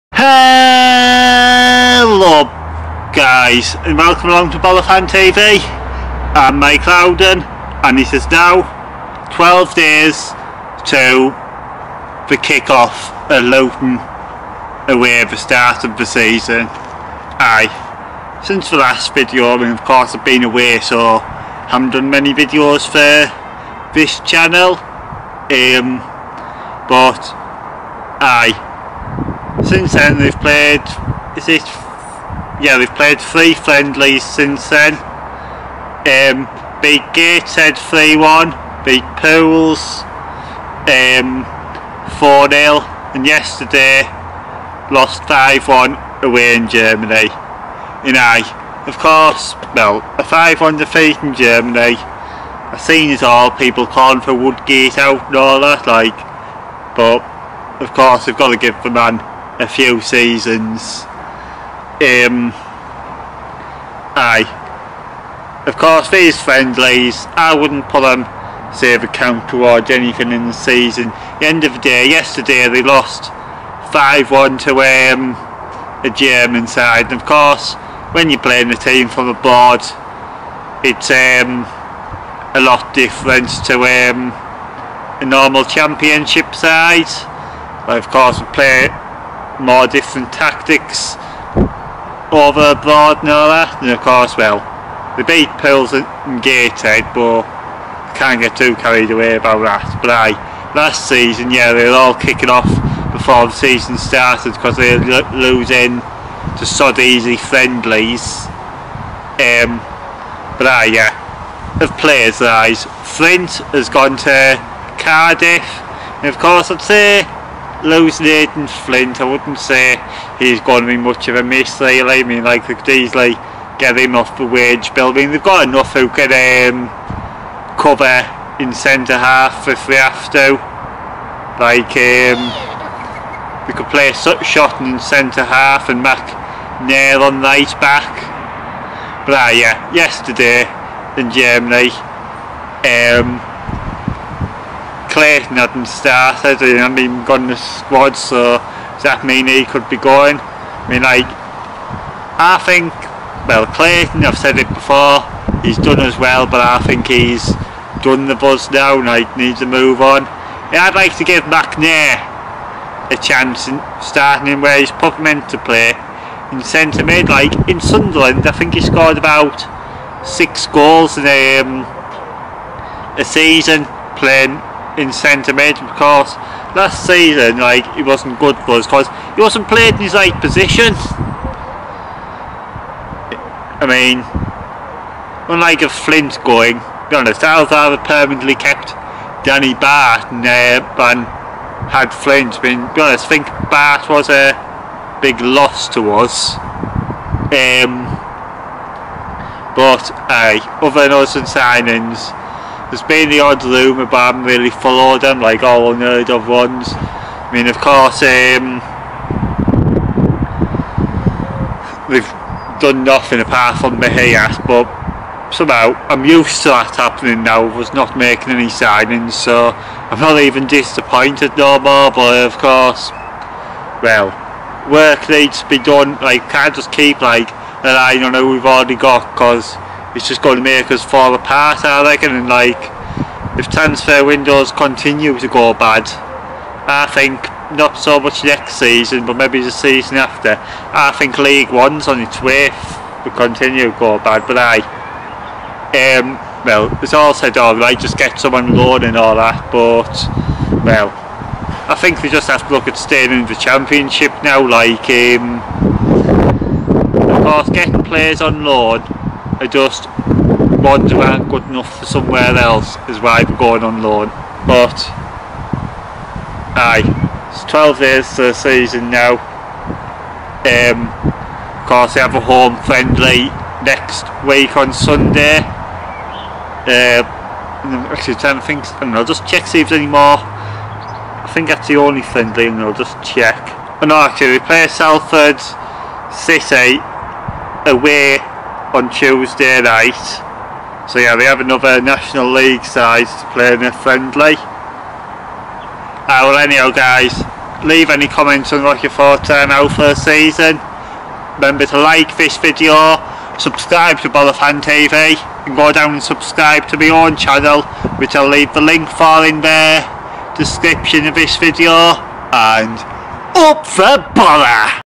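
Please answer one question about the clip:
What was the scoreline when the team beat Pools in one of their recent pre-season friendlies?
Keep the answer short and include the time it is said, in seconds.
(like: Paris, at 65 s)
4-0, at 40 s.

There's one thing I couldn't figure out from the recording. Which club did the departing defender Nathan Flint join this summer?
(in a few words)
Cardiff.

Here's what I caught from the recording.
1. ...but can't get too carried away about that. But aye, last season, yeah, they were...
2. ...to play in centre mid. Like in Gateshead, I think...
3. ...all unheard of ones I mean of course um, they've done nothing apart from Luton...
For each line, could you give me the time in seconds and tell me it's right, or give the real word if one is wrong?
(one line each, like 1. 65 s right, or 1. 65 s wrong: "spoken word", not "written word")
1. 97 s right
2. 165 s wrong: "Sunderland", not "Gateshead"
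3. 205 s wrong: "Mejias", not "Luton".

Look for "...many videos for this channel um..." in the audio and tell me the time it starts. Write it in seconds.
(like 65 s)
22 s.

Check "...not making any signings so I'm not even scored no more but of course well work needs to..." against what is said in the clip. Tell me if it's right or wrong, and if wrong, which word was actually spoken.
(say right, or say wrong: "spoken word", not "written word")
wrong: "disappointed", not "scored".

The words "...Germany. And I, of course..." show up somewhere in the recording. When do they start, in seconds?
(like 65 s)
46 s.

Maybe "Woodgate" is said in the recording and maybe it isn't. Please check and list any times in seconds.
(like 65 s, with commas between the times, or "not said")
54 s.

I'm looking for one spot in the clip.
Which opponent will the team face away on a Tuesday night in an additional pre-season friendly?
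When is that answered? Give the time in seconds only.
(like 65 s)
284 s.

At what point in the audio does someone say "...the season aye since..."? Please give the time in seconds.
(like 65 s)
15 s.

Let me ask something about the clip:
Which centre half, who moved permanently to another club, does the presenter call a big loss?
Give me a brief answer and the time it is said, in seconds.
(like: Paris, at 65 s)
Danny Batth, at 189 s.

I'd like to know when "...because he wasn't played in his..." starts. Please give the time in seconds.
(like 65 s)
178 s.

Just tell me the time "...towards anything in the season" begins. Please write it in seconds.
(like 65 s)
69 s.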